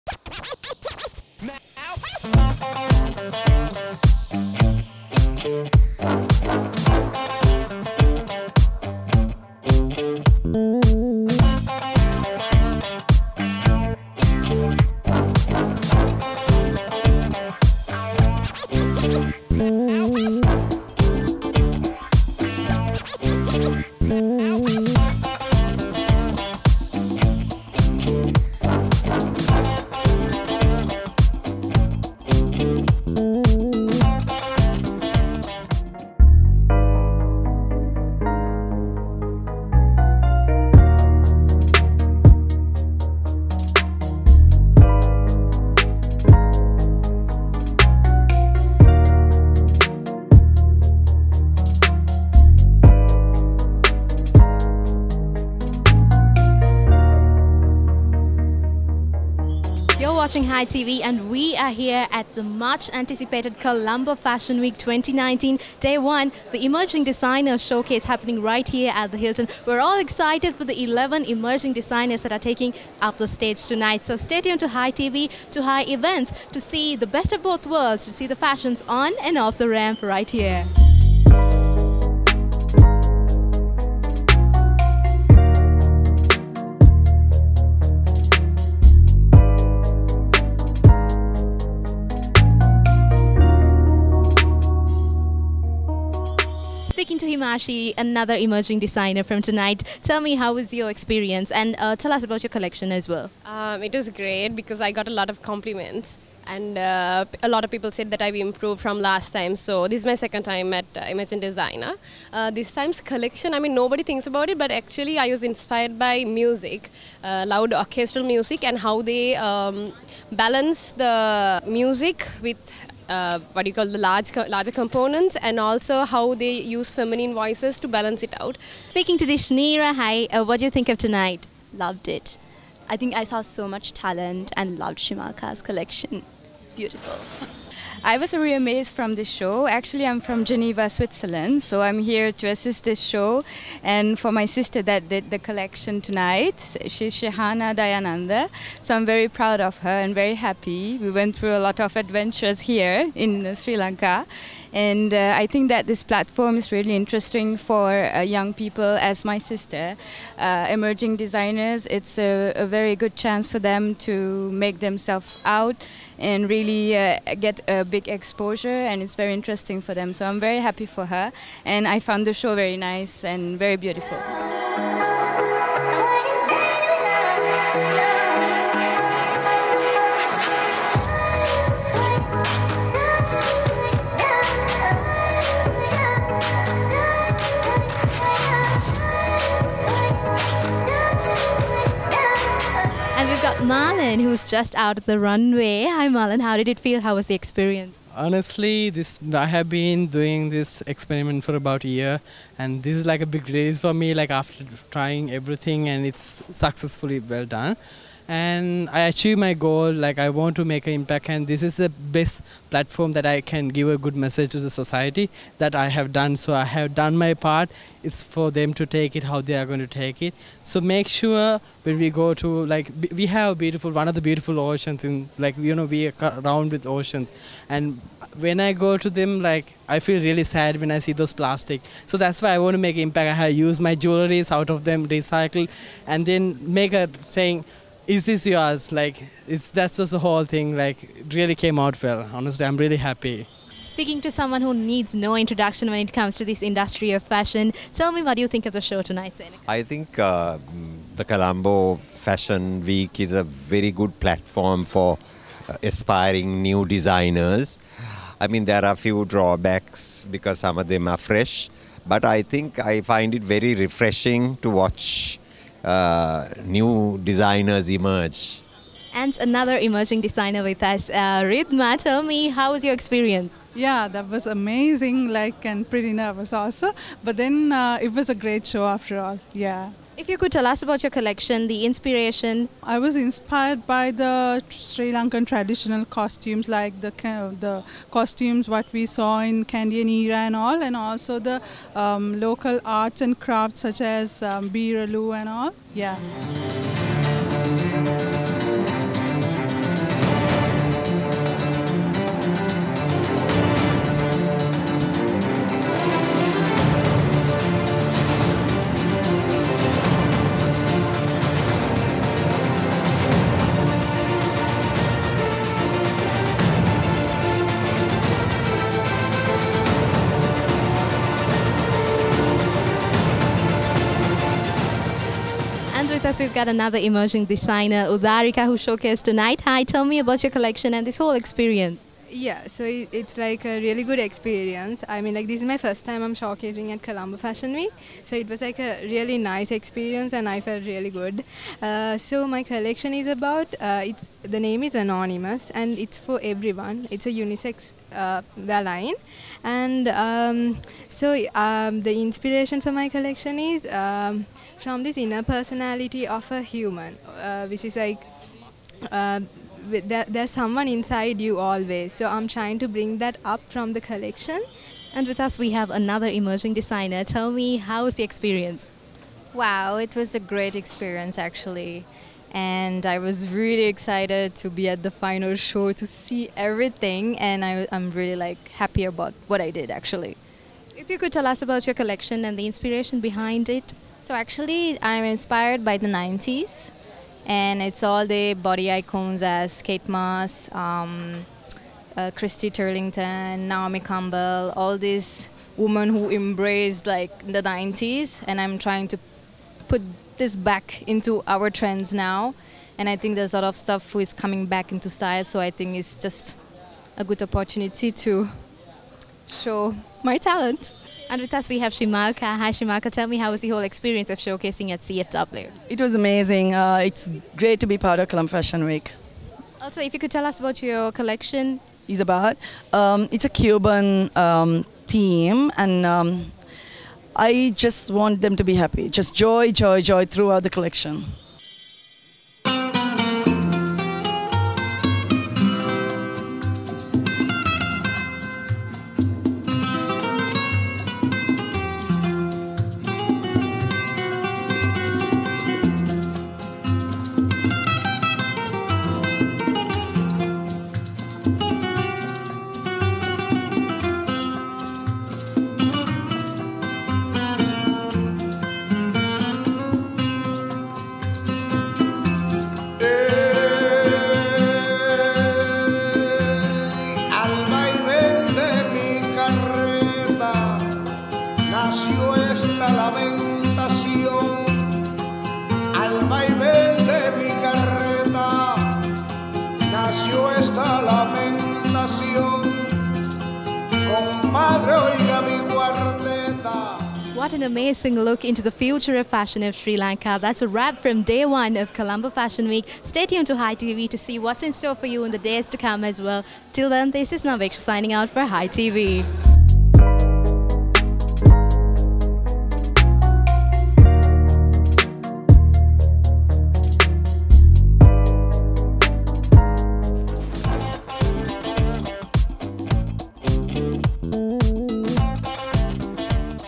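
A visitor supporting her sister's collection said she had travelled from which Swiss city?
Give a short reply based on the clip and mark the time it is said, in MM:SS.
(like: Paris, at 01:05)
Geneva, at 02:20.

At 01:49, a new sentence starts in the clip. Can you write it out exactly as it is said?
So this is my second time at uh, Emerging Designer.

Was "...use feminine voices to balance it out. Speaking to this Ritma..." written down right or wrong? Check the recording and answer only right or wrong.
wrong.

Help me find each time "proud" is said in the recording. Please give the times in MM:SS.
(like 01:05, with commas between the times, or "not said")
02:29.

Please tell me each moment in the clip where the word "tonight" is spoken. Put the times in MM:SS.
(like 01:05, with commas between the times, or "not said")
01:13, 01:39, 02:10, 02:26, 04:09, 05:29.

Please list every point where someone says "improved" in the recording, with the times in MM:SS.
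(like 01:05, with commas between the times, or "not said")
01:48.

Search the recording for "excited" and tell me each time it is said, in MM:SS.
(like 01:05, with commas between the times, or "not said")
01:09, 06:13.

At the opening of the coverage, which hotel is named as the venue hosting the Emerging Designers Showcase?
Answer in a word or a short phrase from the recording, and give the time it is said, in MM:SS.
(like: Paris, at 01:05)
Hilton, at 01:09.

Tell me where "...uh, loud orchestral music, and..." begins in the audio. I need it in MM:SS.
01:57.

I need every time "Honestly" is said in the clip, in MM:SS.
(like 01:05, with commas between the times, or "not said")
03:18, 04:02.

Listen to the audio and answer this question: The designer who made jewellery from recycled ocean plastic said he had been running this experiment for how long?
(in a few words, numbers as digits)
about a year.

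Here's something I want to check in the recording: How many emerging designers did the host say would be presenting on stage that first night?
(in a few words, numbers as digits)
11.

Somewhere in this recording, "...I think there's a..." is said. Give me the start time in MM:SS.
06:43.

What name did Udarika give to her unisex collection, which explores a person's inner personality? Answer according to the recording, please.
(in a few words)
Anonymous.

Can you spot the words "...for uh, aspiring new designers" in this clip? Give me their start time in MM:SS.
04:14.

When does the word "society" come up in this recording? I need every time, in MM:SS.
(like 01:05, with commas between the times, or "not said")
03:34.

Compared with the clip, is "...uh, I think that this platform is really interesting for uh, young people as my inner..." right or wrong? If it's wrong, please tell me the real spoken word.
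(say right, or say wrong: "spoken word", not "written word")
wrong: "sister", not "inner".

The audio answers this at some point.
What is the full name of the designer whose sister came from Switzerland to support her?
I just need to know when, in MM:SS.
02:27.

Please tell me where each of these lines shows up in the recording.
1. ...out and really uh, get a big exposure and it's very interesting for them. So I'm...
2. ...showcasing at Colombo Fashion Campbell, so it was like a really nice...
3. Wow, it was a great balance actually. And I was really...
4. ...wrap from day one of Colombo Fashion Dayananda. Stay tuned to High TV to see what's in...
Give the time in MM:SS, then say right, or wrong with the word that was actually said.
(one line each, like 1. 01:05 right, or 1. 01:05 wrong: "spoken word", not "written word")
1. 02:45 right
2. 05:36 wrong: "Week", not "Campbell"
3. 06:09 wrong: "experience", not "balance"
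4. 08:10 wrong: "Week", not "Dayananda".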